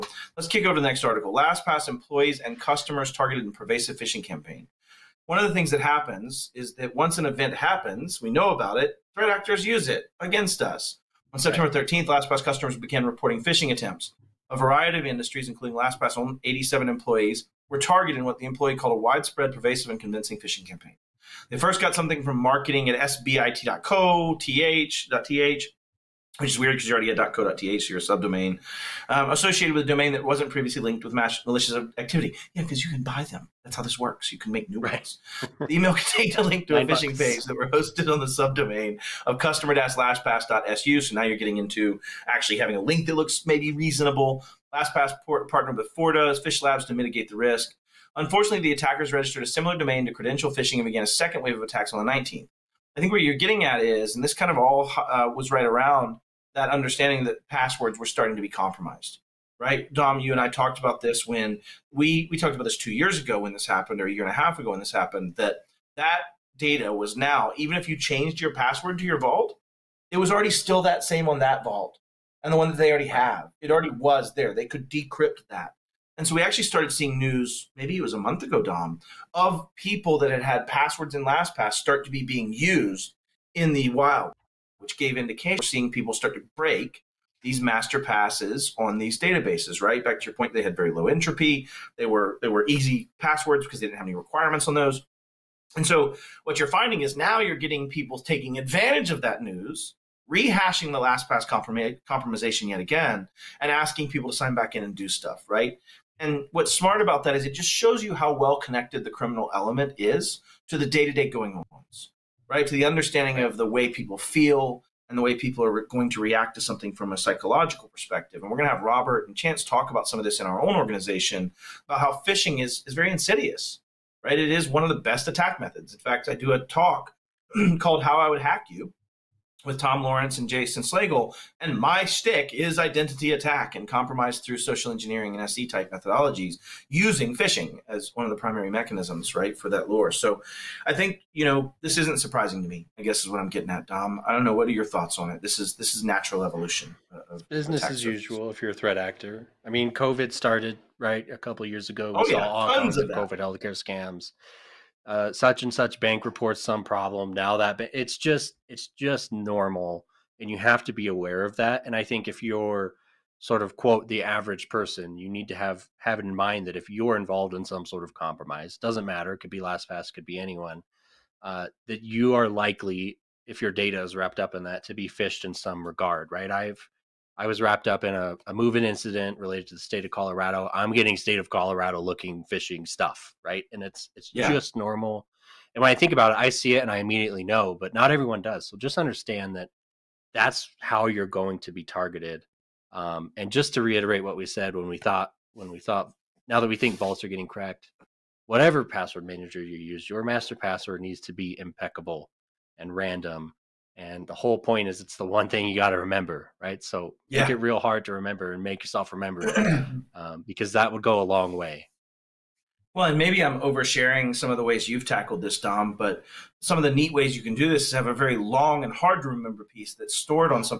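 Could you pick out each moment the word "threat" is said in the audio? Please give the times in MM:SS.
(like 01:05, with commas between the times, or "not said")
00:09, 02:28.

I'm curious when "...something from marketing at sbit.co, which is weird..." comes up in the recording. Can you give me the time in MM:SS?
00:21.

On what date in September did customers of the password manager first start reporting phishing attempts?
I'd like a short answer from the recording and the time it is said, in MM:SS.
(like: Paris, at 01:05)
September 13th, at 00:11.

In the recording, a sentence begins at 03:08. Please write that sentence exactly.
So just understand that that's how you're going to be targeted.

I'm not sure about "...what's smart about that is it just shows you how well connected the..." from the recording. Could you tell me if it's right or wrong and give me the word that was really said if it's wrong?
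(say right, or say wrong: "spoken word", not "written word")
right.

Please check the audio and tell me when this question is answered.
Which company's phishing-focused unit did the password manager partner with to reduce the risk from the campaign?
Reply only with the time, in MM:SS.
00:45.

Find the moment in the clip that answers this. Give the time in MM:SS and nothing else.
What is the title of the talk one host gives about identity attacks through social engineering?
02:08.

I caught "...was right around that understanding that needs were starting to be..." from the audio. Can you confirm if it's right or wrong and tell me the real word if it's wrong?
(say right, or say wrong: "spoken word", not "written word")
wrong: "passwords", not "needs".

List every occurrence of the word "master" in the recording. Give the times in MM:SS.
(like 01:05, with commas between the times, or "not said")
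01:27, 03:20.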